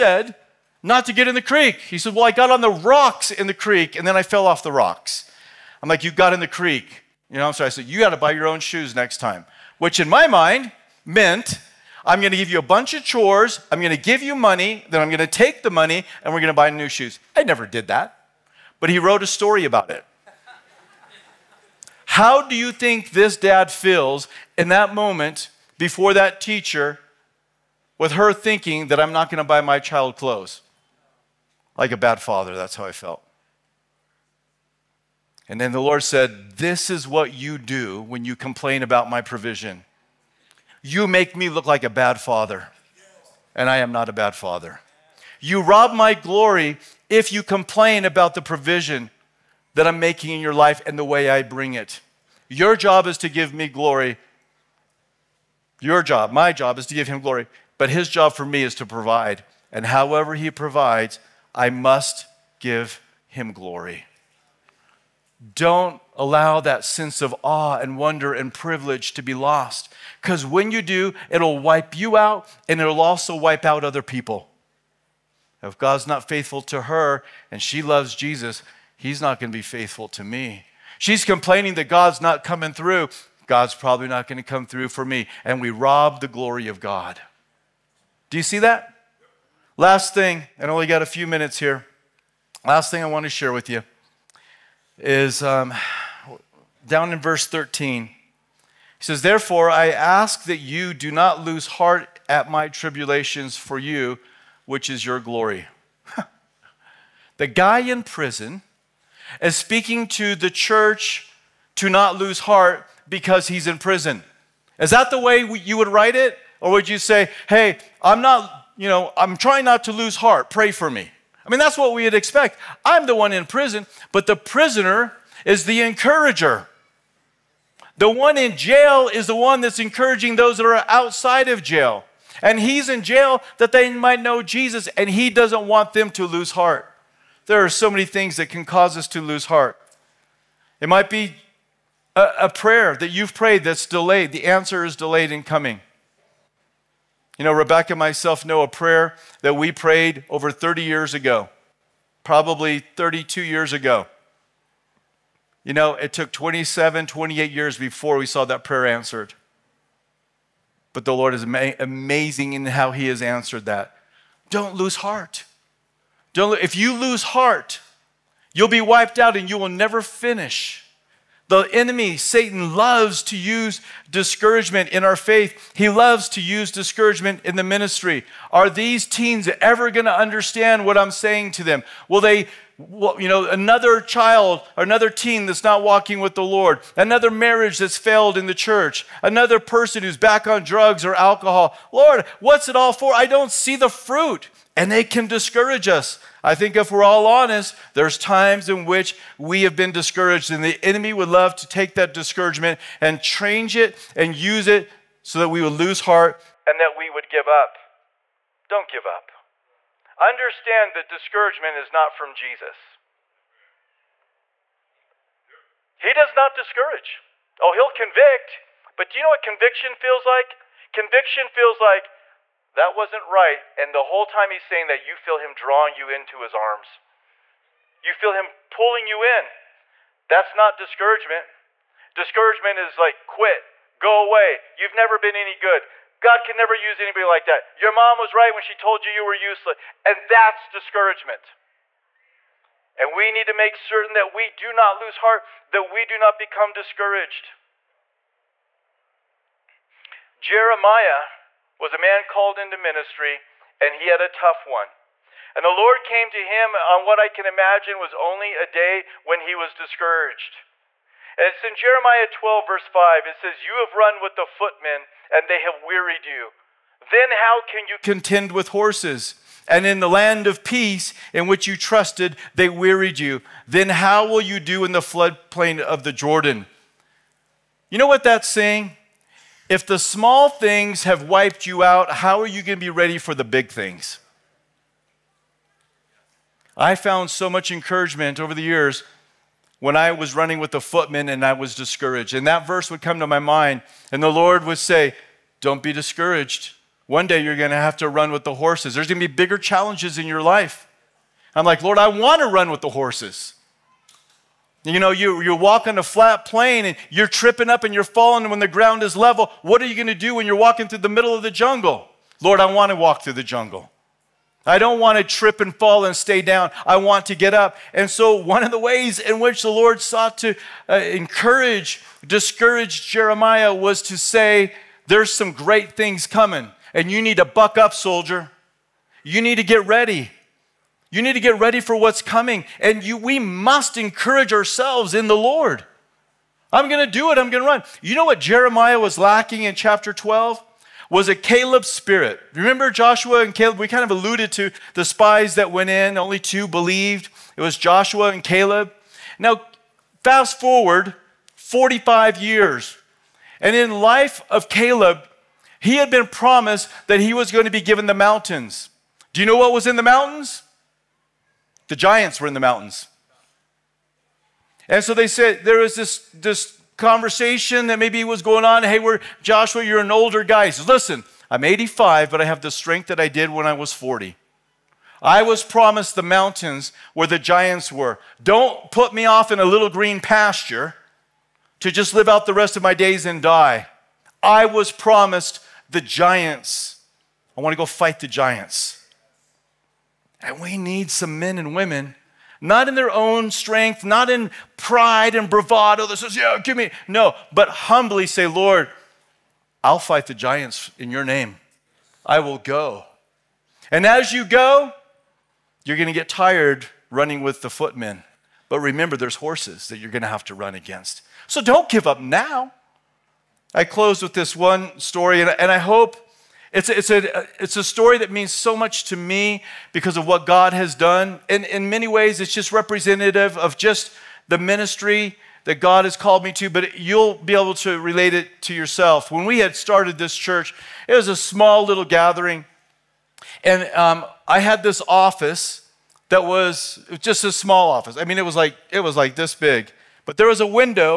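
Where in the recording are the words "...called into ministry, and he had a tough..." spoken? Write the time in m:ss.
4:12.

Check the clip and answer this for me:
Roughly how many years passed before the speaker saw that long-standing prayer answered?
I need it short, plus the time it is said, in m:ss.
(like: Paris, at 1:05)
27 or 28 years, at 2:36.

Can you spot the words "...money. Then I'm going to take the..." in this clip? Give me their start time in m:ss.
0:14.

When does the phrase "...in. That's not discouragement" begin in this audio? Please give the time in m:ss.
3:49.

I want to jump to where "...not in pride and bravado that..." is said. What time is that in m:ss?
6:34.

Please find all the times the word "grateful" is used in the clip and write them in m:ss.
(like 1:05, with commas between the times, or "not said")
not said.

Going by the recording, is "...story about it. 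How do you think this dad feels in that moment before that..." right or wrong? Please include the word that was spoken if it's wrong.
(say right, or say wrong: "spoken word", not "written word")
right.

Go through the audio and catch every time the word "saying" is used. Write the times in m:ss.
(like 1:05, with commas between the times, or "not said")
3:01, 3:44, 4:38.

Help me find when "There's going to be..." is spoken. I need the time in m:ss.
4:58.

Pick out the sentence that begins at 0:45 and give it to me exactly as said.
You rob my glory if you complain about the provision that I'm making in your life and the way I bring it.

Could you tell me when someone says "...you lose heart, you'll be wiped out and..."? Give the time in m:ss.
2:46.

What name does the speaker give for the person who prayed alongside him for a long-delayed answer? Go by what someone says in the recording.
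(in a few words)
Rebecca.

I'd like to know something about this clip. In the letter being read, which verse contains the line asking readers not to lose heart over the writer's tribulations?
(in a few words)
Verse 13.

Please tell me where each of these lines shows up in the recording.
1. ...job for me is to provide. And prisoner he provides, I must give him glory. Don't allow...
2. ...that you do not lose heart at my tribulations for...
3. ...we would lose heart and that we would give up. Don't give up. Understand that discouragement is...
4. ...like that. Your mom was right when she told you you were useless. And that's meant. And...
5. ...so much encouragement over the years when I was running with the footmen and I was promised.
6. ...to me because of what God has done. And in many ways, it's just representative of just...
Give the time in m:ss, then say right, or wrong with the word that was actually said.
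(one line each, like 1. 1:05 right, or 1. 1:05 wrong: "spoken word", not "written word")
1. 0:58 wrong: "however", not "prisoner"
2. 1:40 right
3. 3:25 right
4. 3:57 wrong: "discouragement", not "meant"
5. 4:47 wrong: "discouraged", not "promised"
6. 6:59 right.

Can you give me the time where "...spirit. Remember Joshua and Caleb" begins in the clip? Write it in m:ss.
5:41.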